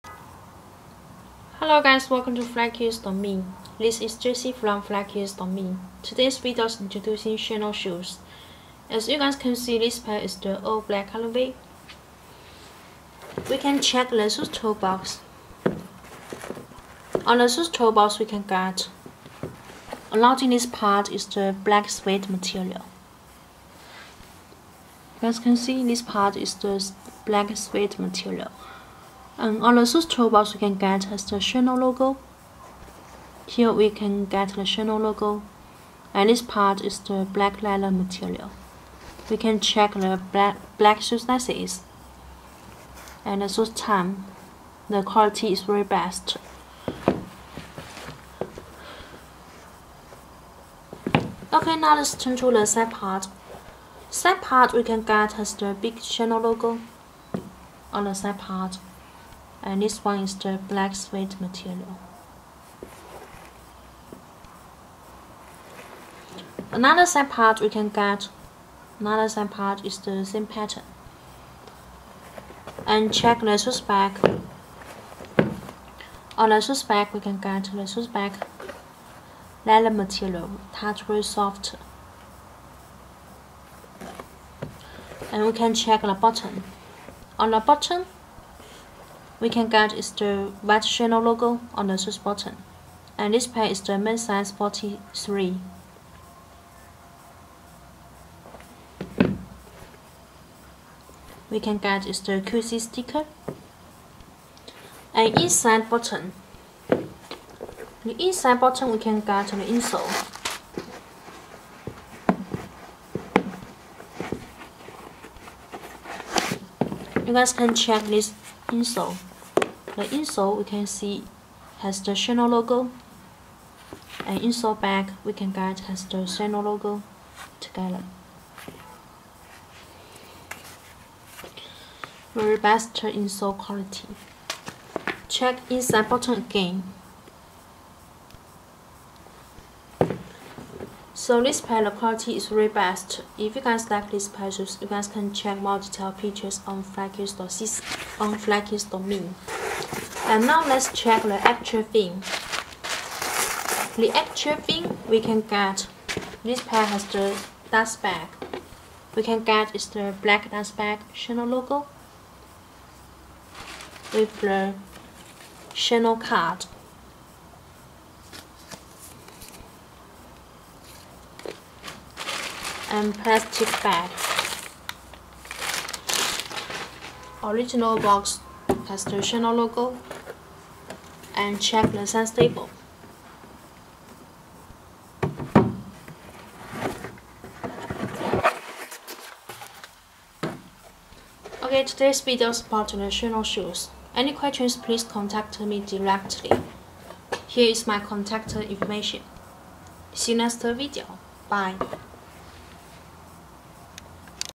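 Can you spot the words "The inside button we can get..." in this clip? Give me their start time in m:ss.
1:46.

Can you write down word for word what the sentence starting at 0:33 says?
Here we can get the Chanel logo.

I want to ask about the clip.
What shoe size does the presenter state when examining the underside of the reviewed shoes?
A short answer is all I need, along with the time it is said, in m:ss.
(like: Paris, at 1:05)
43, at 1:34.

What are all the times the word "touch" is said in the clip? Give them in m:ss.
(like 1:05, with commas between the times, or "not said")
1:20.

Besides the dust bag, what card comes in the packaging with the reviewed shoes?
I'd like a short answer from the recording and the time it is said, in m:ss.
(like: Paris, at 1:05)
Chanel card, at 2:45.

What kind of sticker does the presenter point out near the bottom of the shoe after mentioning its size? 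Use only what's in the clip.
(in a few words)
QC sticker.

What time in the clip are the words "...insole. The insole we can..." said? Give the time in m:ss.
1:58.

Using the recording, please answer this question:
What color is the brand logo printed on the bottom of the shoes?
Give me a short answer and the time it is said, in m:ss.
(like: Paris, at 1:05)
White, at 1:30.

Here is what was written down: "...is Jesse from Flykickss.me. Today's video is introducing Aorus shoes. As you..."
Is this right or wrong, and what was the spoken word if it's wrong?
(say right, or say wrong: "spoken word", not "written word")
wrong: "Chanel", not "Aorus".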